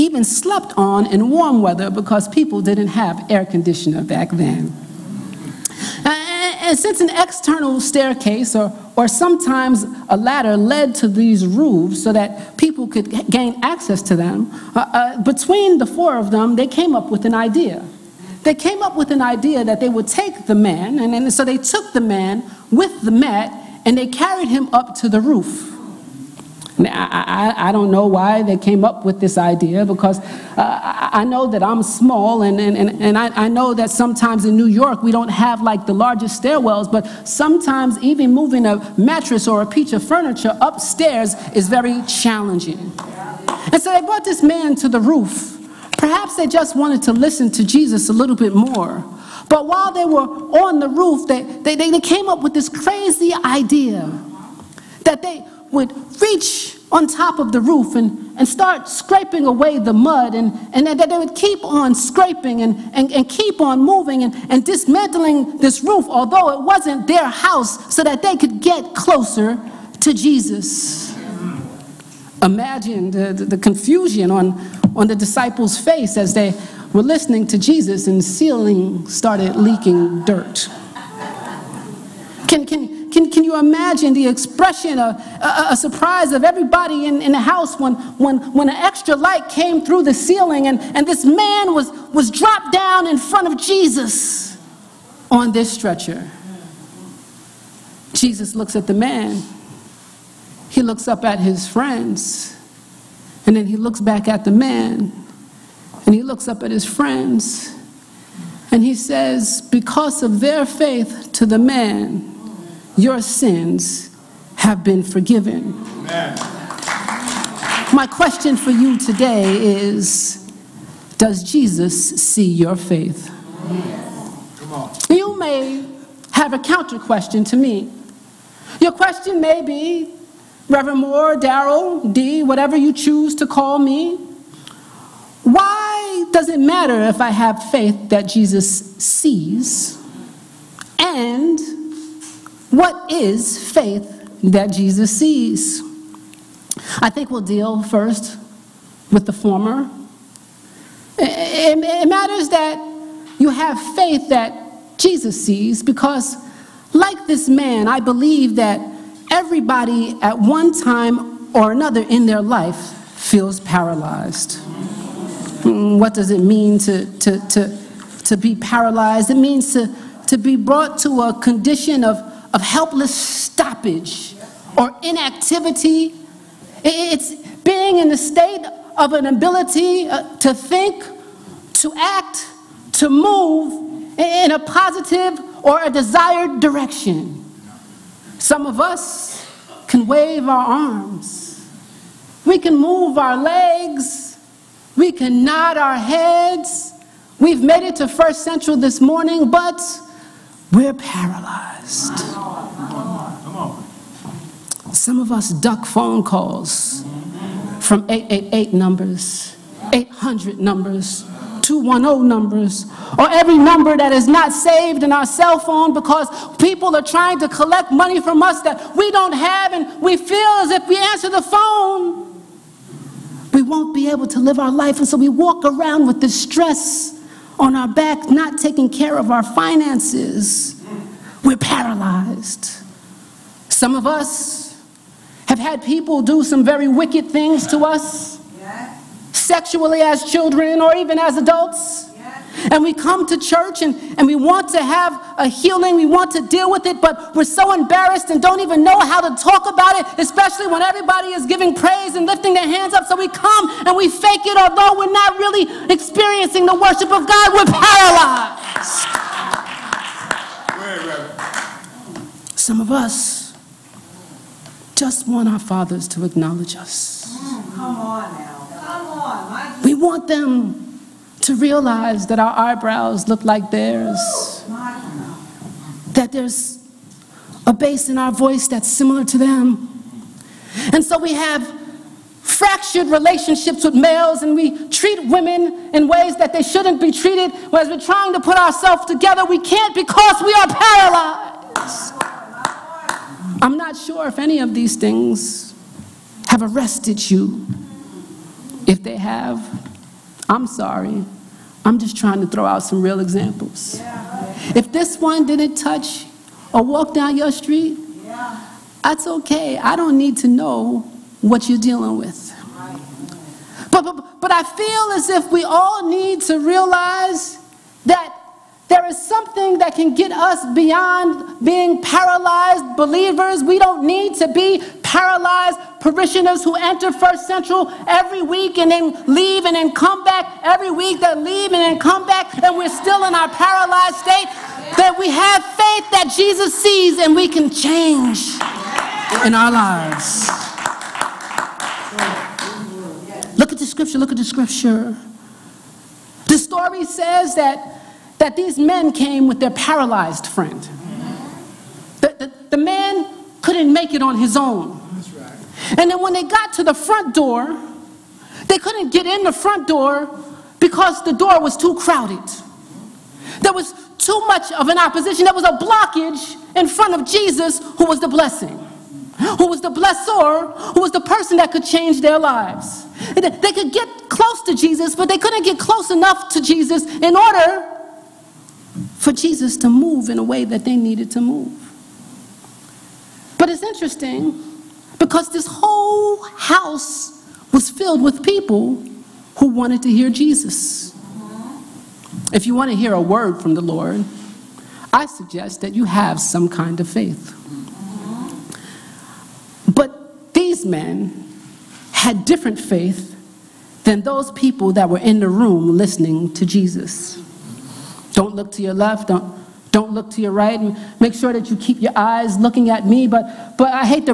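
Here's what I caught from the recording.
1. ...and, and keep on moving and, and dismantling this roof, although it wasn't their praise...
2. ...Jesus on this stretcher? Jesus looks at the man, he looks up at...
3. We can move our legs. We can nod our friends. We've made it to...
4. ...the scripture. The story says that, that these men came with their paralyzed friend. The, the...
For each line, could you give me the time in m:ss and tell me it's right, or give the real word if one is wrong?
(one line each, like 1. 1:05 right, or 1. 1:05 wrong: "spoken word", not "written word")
1. 1:02 wrong: "house", not "praise"
2. 1:33 right
3. 3:12 wrong: "heads", not "friends"
4. 5:44 right.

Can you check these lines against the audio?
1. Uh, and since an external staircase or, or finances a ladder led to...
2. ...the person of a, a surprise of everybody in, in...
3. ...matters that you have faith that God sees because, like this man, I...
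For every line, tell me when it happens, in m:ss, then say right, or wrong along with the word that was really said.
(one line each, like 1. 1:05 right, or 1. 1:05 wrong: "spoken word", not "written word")
1. 0:06 wrong: "sometimes", not "finances"
2. 1:24 wrong: "expression", not "person"
3. 2:32 wrong: "Jesus", not "God".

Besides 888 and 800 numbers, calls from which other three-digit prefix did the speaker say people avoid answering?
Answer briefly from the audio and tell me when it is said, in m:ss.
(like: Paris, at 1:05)
210, at 3:31.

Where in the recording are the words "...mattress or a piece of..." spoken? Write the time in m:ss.
0:38.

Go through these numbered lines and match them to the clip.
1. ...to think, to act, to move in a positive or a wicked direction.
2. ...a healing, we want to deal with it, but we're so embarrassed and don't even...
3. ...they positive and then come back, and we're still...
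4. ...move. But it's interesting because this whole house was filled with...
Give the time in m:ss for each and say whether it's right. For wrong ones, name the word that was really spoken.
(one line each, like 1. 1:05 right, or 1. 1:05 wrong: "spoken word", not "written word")
1. 3:00 wrong: "desired", not "wicked"
2. 4:05 right
3. 5:31 wrong: "leave", not "positive"
4. 6:21 right.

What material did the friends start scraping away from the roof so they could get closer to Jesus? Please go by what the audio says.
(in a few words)
mud.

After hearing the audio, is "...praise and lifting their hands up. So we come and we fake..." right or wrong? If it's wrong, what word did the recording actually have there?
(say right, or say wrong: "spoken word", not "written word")
right.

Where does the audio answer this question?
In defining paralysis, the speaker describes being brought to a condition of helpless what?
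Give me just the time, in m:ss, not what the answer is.
2:53.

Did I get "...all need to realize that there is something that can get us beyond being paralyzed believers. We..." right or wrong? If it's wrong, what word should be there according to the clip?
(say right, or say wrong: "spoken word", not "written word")
right.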